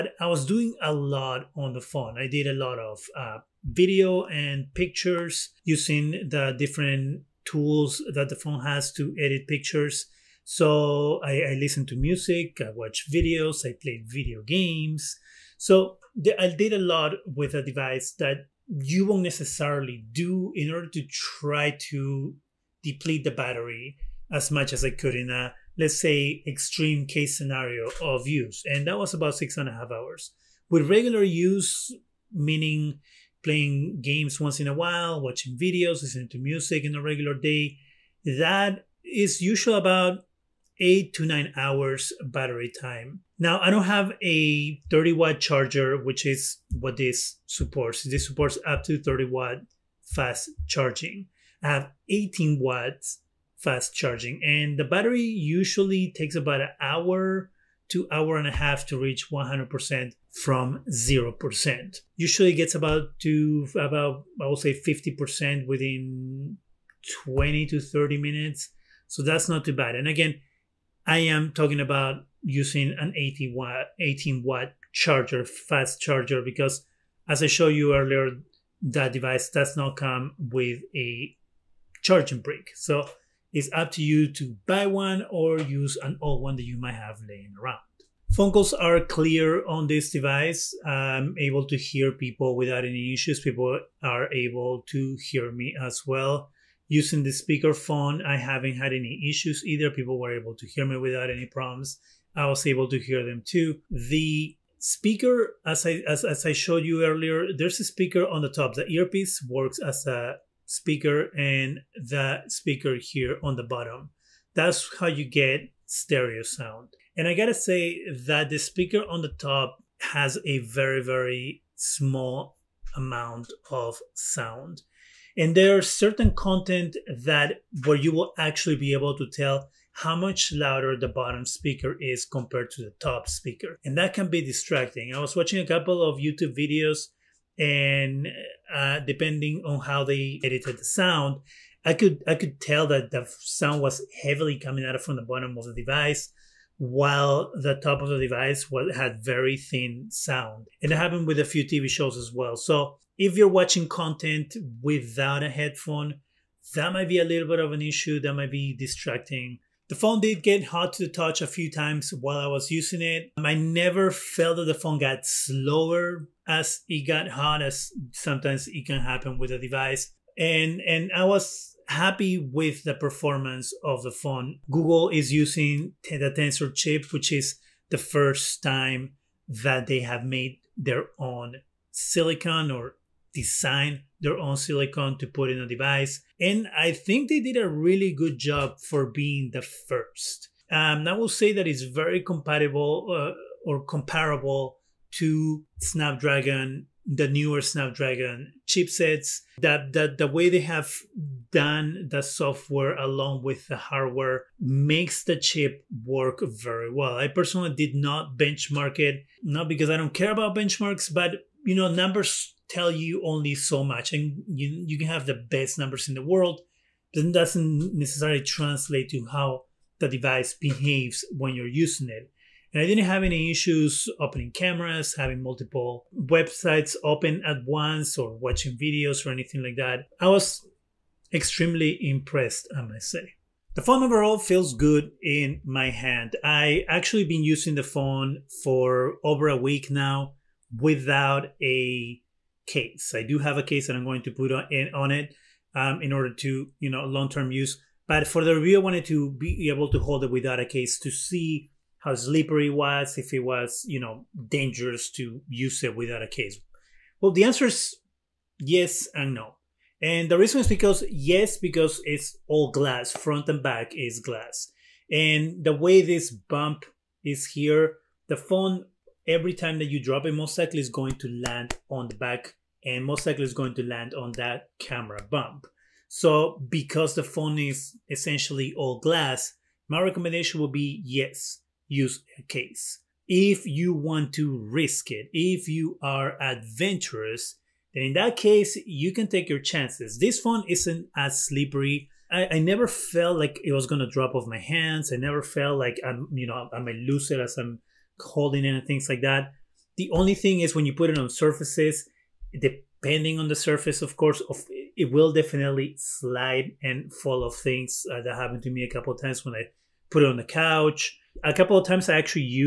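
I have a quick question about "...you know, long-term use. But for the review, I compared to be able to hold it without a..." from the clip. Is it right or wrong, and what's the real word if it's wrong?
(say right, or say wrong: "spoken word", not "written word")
wrong: "wanted", not "compared".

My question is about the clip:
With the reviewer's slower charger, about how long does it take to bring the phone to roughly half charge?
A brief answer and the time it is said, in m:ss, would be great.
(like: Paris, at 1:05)
20 to 30 minutes, at 1:07.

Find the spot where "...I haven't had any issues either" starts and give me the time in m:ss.
1:38.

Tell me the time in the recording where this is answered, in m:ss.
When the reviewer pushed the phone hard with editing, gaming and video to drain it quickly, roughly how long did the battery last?
0:29.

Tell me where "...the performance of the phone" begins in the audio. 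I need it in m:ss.
2:52.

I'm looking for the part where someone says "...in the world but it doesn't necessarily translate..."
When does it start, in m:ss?
3:36.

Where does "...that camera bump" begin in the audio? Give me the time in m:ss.
4:34.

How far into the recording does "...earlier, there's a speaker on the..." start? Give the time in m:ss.
1:47.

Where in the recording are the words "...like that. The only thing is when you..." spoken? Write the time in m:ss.
4:59.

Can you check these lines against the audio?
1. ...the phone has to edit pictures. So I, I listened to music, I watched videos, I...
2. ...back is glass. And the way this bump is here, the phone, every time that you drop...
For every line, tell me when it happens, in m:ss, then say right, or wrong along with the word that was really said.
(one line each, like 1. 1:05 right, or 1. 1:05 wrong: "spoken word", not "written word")
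1. 0:08 right
2. 4:23 right.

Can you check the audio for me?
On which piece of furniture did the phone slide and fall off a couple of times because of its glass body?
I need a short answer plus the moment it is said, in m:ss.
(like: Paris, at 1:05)
The couch, at 5:10.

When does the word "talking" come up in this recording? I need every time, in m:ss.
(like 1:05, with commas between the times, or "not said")
1:11.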